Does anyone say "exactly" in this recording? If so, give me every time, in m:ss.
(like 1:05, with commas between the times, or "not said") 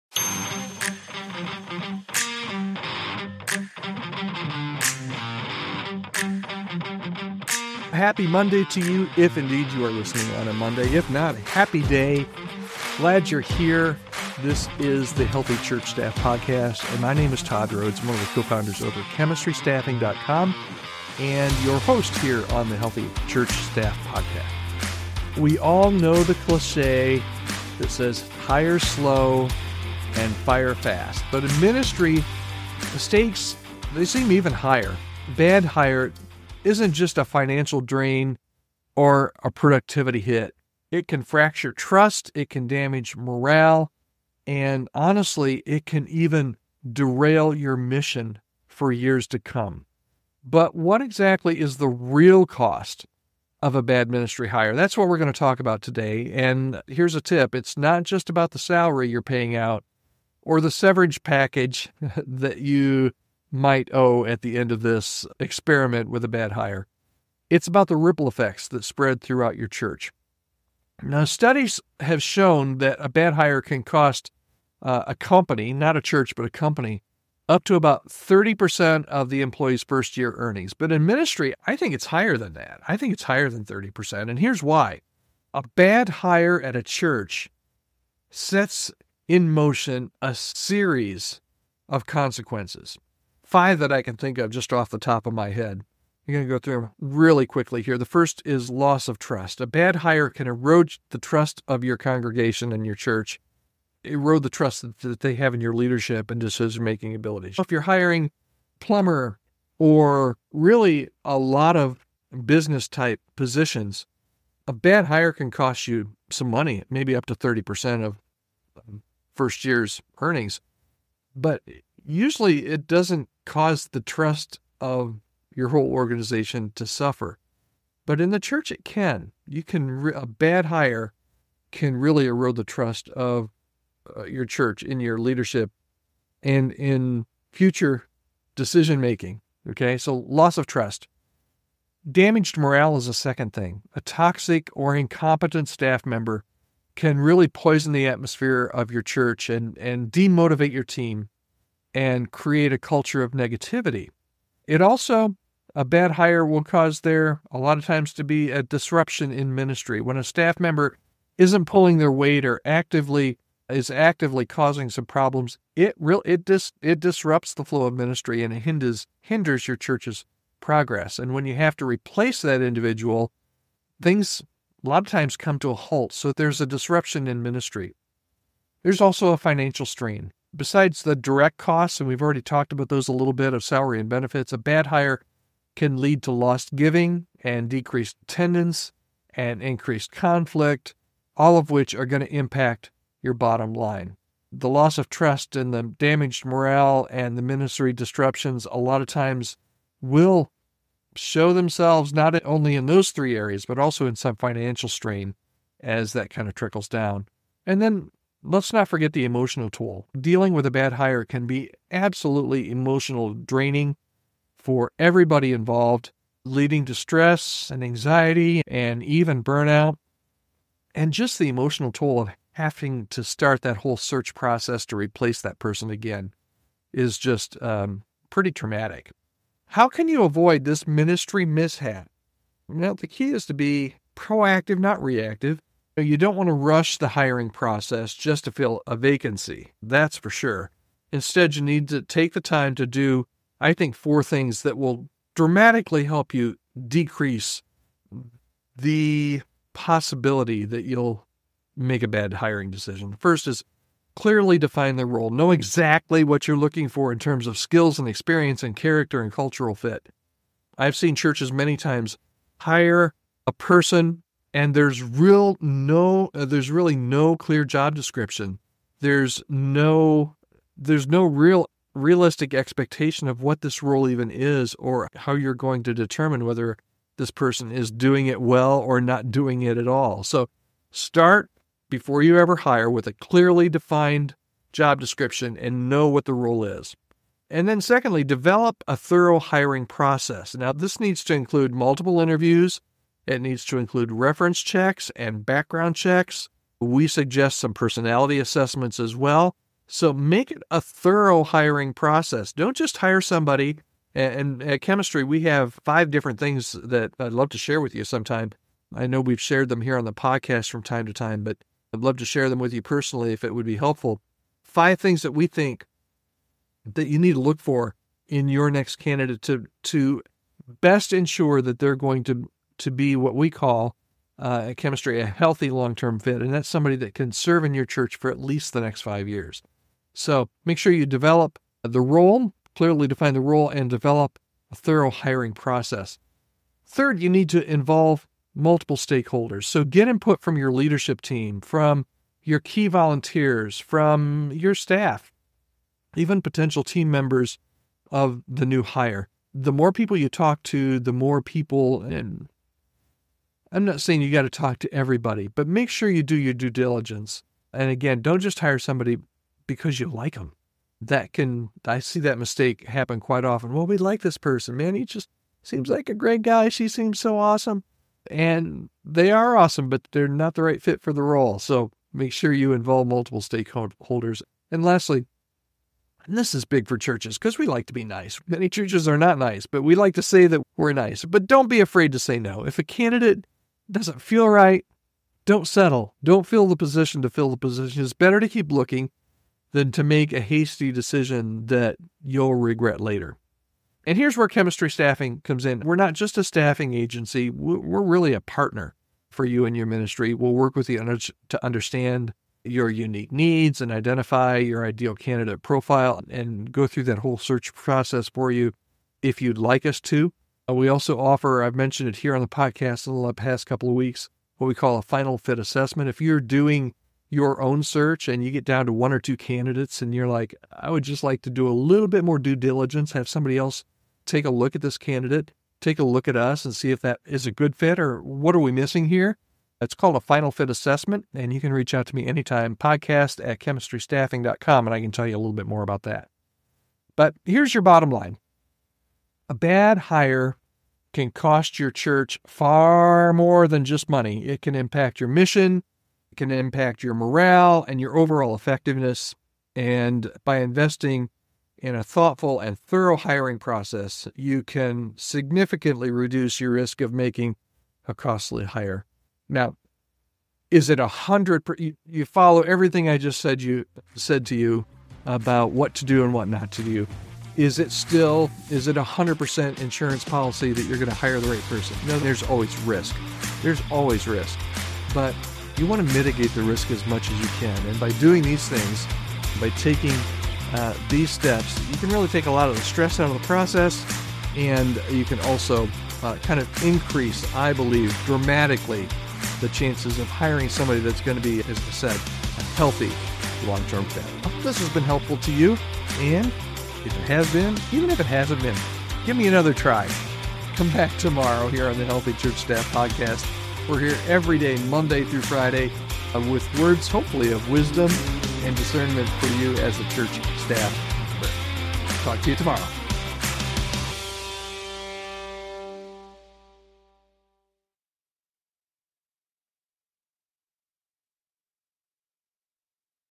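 0:51, 4:15.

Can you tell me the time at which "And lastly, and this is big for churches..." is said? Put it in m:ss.
6:14.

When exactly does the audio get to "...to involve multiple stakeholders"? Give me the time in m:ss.
5:37.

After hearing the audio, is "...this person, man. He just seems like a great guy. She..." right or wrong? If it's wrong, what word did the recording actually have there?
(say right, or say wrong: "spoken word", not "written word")
right.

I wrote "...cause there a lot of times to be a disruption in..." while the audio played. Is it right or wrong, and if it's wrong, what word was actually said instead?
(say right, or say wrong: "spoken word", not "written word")
right.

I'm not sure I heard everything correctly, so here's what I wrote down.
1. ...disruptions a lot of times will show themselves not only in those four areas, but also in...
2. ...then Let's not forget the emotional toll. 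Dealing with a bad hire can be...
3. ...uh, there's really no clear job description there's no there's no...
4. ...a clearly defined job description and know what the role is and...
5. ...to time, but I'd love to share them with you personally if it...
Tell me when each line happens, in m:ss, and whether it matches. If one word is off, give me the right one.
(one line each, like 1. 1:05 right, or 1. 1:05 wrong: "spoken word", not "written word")
1. 3:17 wrong: "three", not "four"
2. 3:27 right
3. 4:26 right
4. 4:43 right
5. 5:11 right.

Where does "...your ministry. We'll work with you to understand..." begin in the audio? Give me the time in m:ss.
6:39.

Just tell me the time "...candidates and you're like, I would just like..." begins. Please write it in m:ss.
6:59.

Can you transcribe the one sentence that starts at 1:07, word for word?
It's about the ripple effects that spread throughout your church.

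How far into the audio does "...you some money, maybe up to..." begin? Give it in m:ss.
1:55.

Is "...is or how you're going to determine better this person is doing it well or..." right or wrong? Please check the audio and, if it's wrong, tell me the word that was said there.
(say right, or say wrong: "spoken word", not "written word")
wrong: "whether", not "better".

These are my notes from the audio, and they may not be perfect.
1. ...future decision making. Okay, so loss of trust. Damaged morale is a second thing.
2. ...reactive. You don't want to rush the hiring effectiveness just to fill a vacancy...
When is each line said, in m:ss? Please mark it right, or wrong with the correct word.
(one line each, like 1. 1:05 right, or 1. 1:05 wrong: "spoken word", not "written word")
1. 2:17 right
2. 3:55 wrong: "process", not "effectiveness".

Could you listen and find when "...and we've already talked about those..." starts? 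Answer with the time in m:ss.
3:01.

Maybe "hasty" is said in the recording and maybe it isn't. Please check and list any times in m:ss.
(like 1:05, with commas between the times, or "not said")
6:30.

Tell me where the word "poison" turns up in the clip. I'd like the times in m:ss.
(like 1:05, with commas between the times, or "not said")
2:27.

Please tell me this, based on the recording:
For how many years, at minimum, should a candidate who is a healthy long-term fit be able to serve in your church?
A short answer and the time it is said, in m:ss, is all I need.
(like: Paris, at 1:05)
5, at 5:28.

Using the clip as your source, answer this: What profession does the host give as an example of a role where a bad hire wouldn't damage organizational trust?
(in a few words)
Plumber.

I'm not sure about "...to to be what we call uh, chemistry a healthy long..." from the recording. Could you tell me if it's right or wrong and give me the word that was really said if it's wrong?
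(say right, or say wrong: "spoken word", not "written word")
right.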